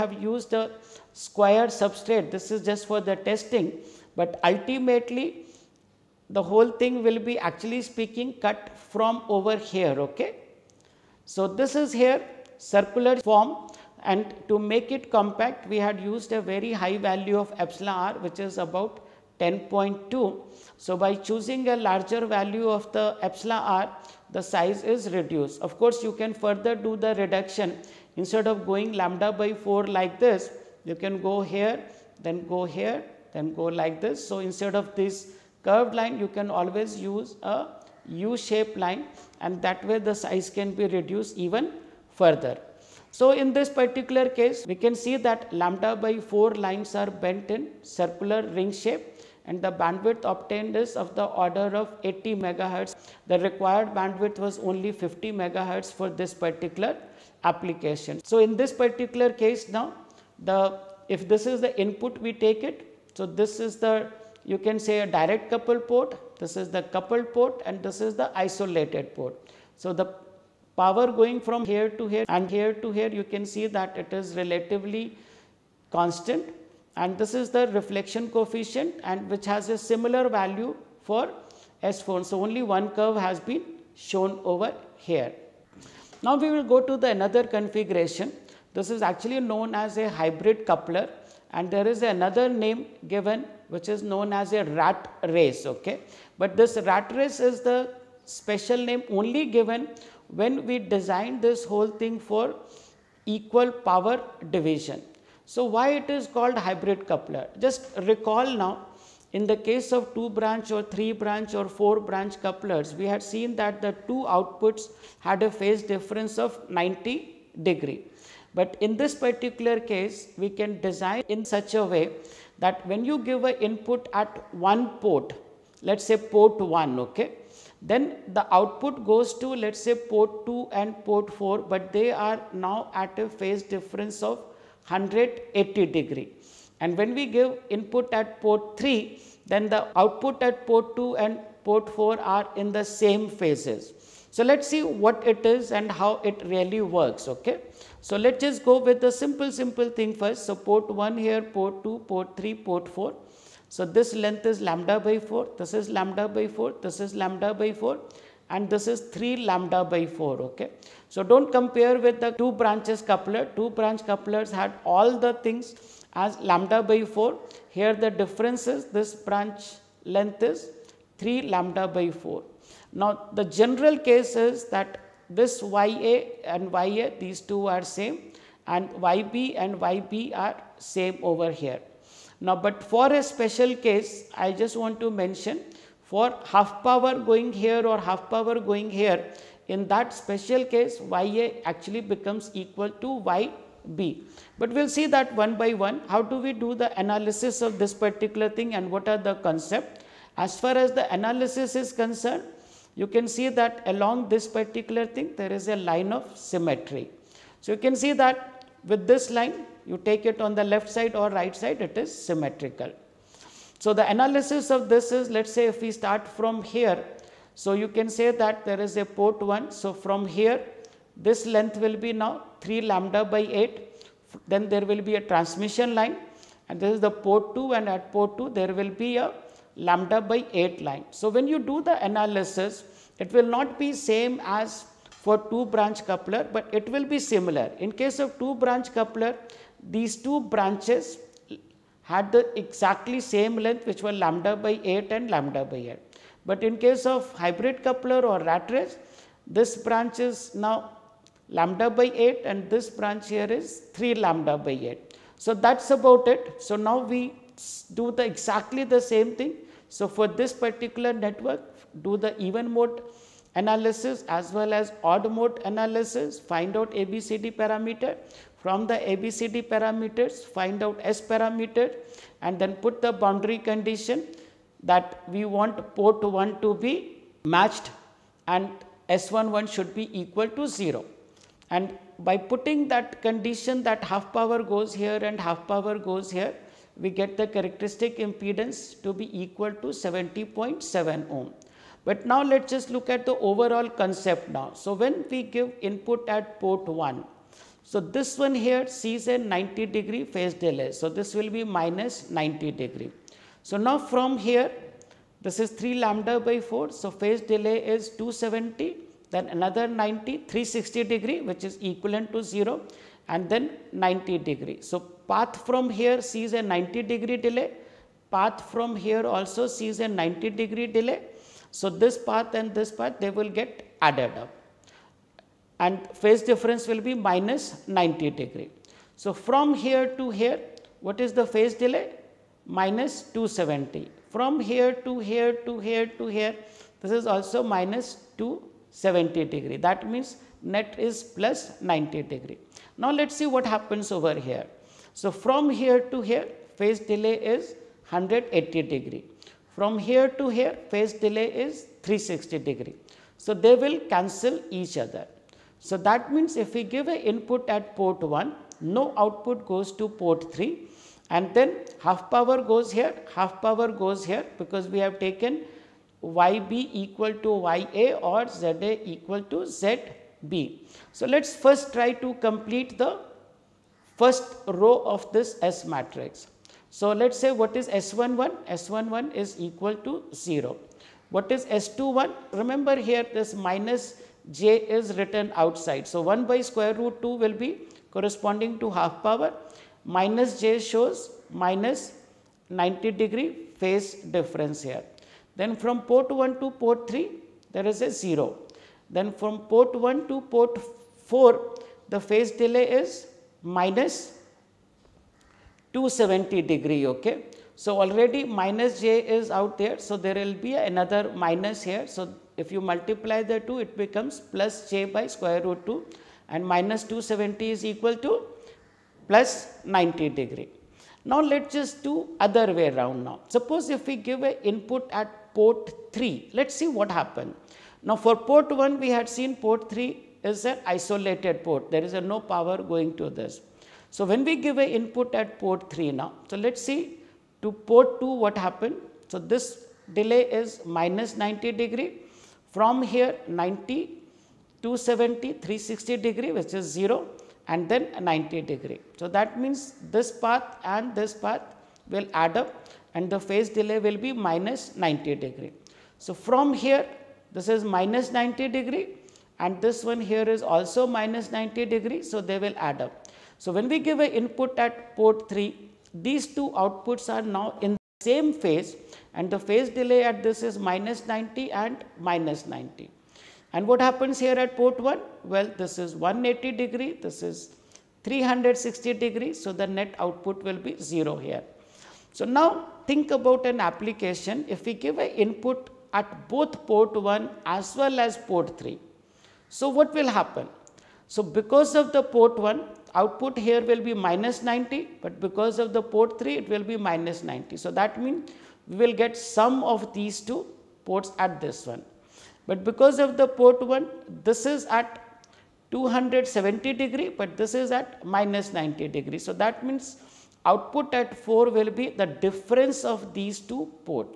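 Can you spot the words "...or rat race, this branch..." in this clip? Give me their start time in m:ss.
4:08.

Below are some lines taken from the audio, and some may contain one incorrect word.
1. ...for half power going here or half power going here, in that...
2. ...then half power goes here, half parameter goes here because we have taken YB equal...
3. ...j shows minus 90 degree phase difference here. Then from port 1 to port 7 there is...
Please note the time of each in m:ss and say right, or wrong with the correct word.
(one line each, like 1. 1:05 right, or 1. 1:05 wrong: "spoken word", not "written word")
1. 3:06 right
2. 6:01 wrong: "power", not "parameter"
3. 6:30 wrong: "3", not "7".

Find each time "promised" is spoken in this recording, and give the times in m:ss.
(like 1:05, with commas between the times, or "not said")
not said.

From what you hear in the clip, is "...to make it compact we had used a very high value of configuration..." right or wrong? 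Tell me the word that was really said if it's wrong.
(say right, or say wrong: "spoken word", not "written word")
wrong: "epsilon", not "configuration".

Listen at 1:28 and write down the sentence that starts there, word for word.
This is actually known as a hybrid coupler and there is another name given which is known as a rat race.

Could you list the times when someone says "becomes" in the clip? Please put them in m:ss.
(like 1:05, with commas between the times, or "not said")
3:12, 6:53.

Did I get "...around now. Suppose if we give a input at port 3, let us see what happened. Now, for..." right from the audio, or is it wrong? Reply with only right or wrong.
right.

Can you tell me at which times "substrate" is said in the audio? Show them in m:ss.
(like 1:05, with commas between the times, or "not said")
0:01.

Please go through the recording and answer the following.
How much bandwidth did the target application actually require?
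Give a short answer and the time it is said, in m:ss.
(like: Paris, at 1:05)
50 MHz, at 0:55.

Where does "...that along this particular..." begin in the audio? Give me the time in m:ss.
3:23.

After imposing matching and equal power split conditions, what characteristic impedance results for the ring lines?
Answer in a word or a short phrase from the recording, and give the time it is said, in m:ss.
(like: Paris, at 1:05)
70.7 ohm, at 4:49.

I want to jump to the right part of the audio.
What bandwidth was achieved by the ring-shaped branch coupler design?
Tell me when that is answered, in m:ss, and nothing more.
0:52.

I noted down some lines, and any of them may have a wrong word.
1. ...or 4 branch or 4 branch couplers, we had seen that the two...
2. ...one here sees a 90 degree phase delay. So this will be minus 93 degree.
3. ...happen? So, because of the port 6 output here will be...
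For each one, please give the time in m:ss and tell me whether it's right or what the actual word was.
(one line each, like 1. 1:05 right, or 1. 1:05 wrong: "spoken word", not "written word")
1. 1:50 wrong: "3", not "4"
2. 4:58 wrong: "90", not "93"
3. 8:10 wrong: "1", not "6".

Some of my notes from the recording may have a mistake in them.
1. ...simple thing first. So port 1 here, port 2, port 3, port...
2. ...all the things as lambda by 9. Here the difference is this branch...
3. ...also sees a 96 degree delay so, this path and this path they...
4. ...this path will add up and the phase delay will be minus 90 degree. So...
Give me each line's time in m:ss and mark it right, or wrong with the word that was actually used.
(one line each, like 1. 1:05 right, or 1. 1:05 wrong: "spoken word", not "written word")
1. 2:29 right
2. 2:44 wrong: "4", not "9"
3. 5:19 wrong: "90", not "96"
4. 7:31 right.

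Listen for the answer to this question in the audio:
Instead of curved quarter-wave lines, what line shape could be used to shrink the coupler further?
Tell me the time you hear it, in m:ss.
0:38.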